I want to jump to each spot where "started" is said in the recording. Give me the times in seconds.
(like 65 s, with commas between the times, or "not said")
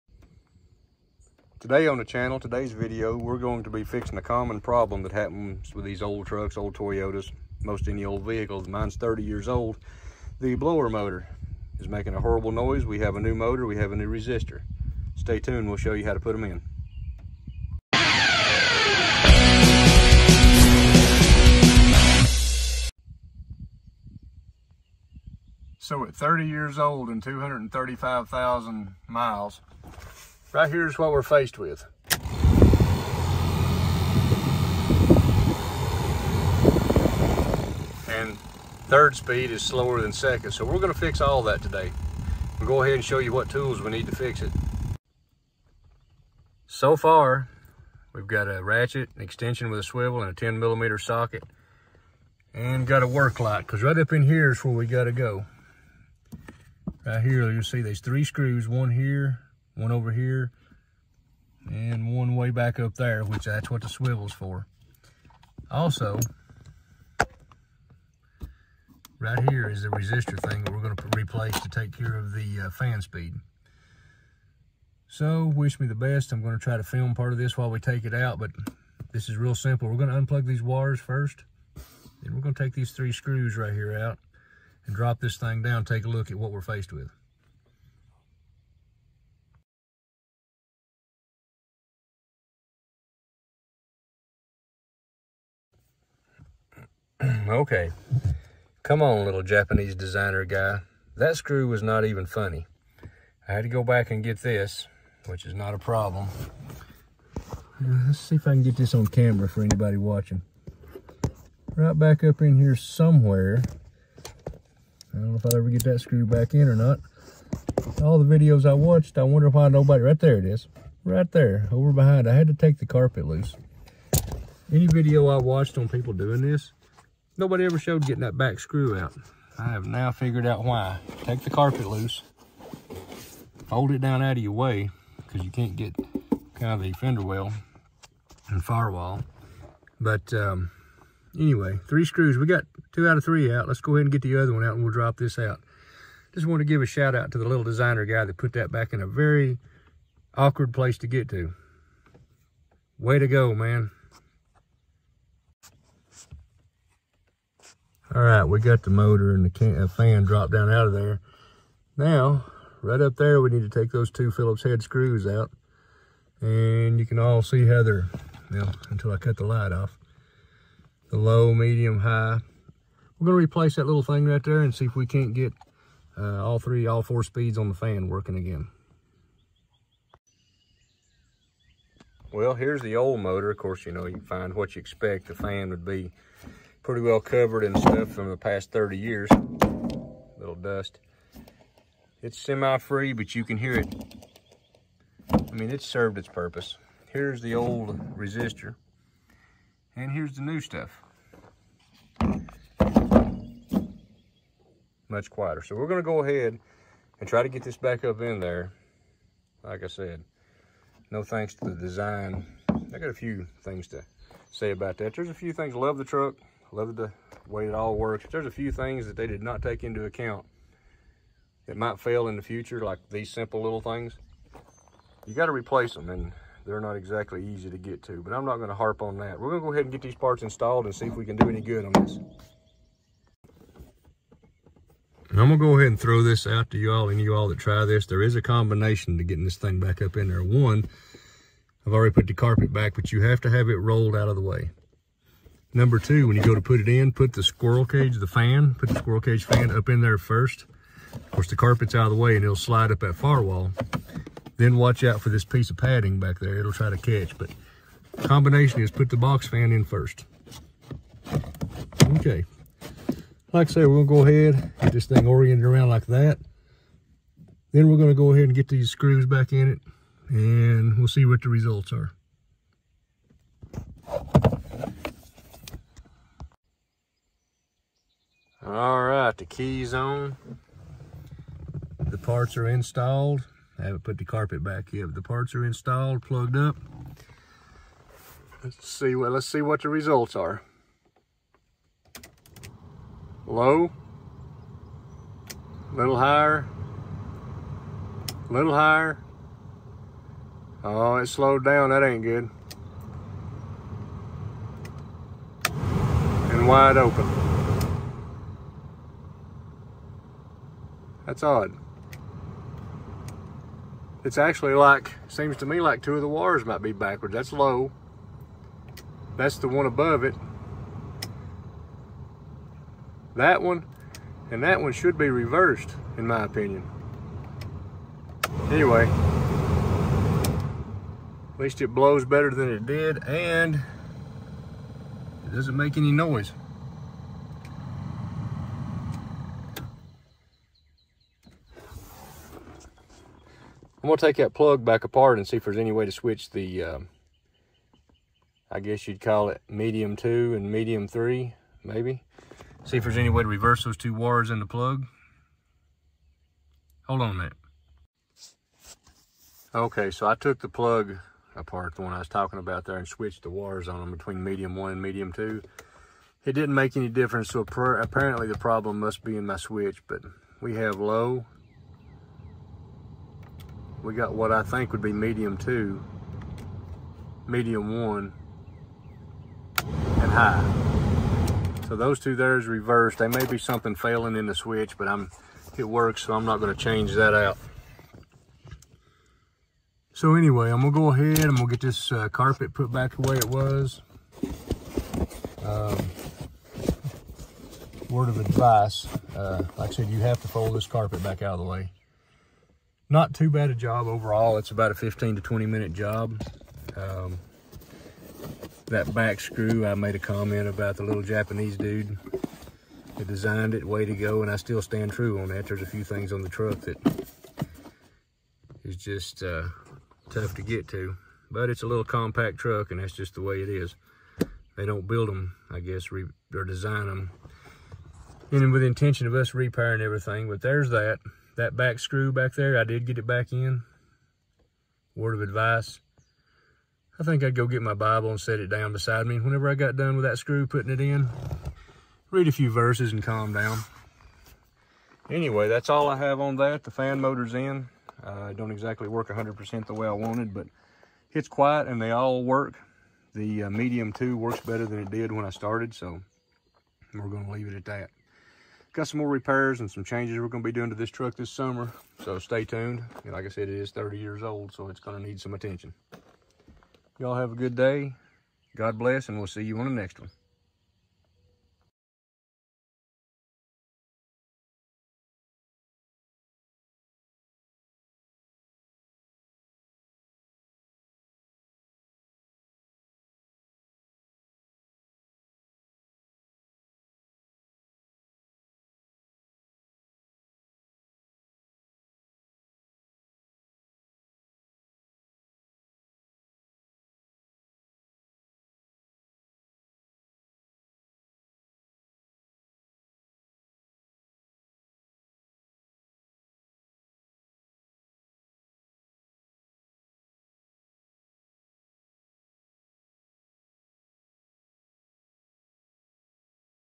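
455 s.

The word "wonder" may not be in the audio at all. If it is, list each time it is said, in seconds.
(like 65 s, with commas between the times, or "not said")
119 s.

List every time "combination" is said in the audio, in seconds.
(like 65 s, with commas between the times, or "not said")
238 s, 258 s.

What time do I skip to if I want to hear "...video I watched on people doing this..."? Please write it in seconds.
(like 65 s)
124 s.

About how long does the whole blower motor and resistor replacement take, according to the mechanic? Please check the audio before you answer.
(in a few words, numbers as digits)
15 to 20 minutes.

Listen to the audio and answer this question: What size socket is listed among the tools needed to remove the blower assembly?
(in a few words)
10 millimeter.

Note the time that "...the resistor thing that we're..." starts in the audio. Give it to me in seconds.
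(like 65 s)
69 s.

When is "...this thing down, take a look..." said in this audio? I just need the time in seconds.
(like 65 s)
85 s.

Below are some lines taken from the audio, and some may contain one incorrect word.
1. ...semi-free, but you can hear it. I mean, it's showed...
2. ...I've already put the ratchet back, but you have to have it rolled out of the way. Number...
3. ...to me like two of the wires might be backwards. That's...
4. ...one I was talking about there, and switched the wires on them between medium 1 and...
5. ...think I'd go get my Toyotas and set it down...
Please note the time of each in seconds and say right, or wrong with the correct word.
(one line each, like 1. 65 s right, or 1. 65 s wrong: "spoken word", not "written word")
1. 192 s wrong: "served", not "showed"
2. 241 s wrong: "carpet", not "ratchet"
3. 315 s right
4. 362 s right
5. 437 s wrong: "Bible", not "Toyotas".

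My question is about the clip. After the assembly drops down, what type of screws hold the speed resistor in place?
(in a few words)
Phillips head.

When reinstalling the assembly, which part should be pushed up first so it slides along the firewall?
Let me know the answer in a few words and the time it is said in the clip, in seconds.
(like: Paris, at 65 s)
squirrel cage fan, at 248 s.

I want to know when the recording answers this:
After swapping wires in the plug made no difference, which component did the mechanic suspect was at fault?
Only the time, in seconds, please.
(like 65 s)
369 s.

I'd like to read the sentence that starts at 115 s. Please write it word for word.
I don't know if I'll ever get that screw back in or not.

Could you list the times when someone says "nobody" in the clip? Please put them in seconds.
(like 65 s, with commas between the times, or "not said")
119 s, 127 s.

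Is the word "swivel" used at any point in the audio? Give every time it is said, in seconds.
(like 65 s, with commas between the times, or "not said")
49 s, 63 s.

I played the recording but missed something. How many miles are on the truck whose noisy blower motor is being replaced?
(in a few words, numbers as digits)
235,000.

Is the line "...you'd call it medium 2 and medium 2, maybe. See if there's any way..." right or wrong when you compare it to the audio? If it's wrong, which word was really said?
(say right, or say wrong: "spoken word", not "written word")
wrong: "3", not "2".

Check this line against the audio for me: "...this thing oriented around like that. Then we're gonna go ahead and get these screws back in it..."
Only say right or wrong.
right.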